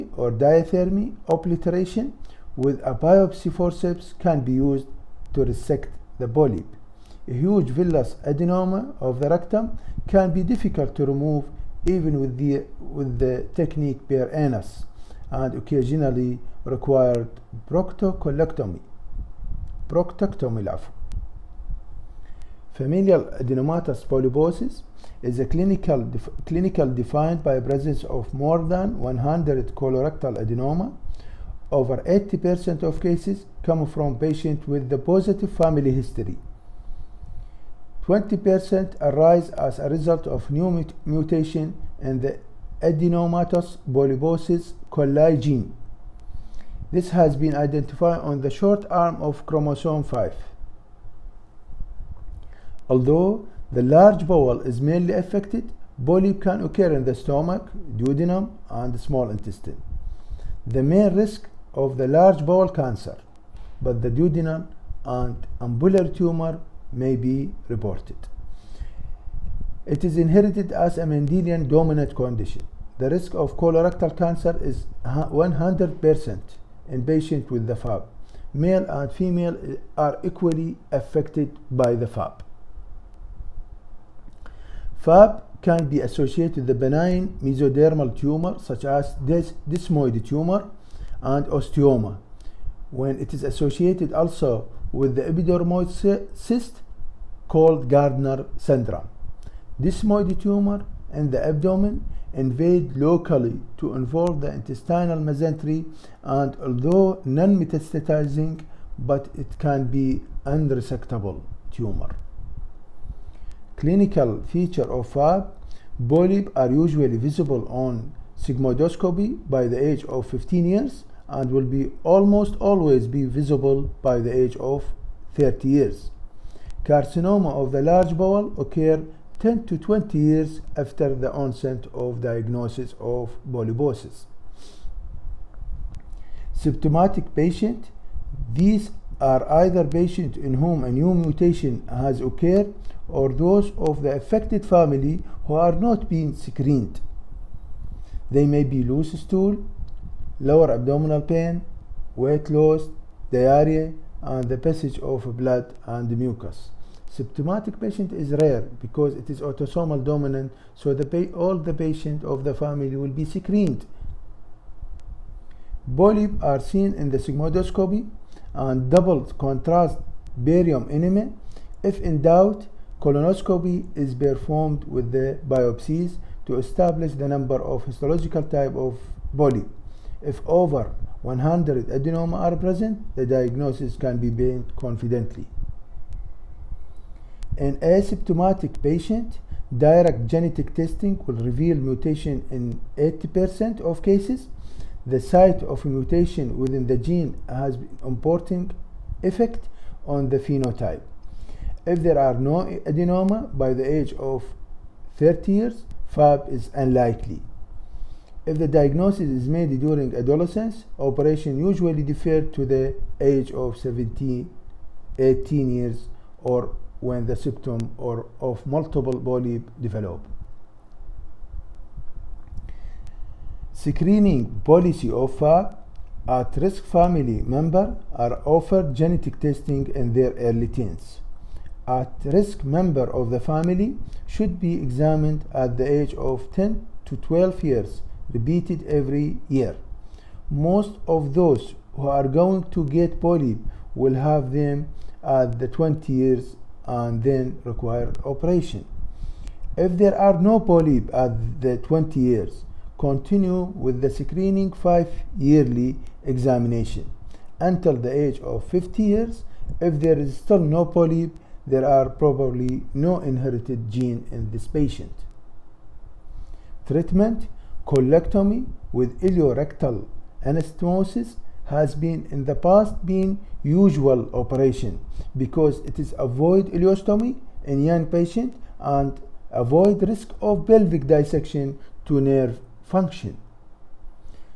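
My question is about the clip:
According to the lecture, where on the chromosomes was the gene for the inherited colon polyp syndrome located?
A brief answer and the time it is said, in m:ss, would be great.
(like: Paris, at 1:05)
Short arm of chromosome 5, at 0:48.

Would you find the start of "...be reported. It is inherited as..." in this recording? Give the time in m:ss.
1:07.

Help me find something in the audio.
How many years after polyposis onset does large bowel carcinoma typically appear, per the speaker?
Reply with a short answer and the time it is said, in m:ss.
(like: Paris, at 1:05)
10 to 20 years, at 2:09.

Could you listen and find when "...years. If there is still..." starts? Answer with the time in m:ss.
4:19.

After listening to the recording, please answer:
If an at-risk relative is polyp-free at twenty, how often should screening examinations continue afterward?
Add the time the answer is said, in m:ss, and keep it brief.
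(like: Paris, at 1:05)
Every 5 years, at 4:14.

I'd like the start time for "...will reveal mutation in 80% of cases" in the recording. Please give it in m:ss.
3:11.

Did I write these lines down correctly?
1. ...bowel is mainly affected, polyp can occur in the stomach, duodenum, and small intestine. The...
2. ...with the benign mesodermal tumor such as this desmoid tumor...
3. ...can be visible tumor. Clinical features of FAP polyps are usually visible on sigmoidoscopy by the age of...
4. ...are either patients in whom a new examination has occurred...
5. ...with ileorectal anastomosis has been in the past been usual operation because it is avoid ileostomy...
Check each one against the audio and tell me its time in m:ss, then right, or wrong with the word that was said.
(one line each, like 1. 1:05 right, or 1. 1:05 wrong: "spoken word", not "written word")
1. 0:54 right
2. 1:26 right
3. 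1:49 wrong: "unresectable", not "visible"
4. 2:19 wrong: "mutation", not "examination"
5. 4:28 right.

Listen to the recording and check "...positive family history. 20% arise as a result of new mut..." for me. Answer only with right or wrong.
right.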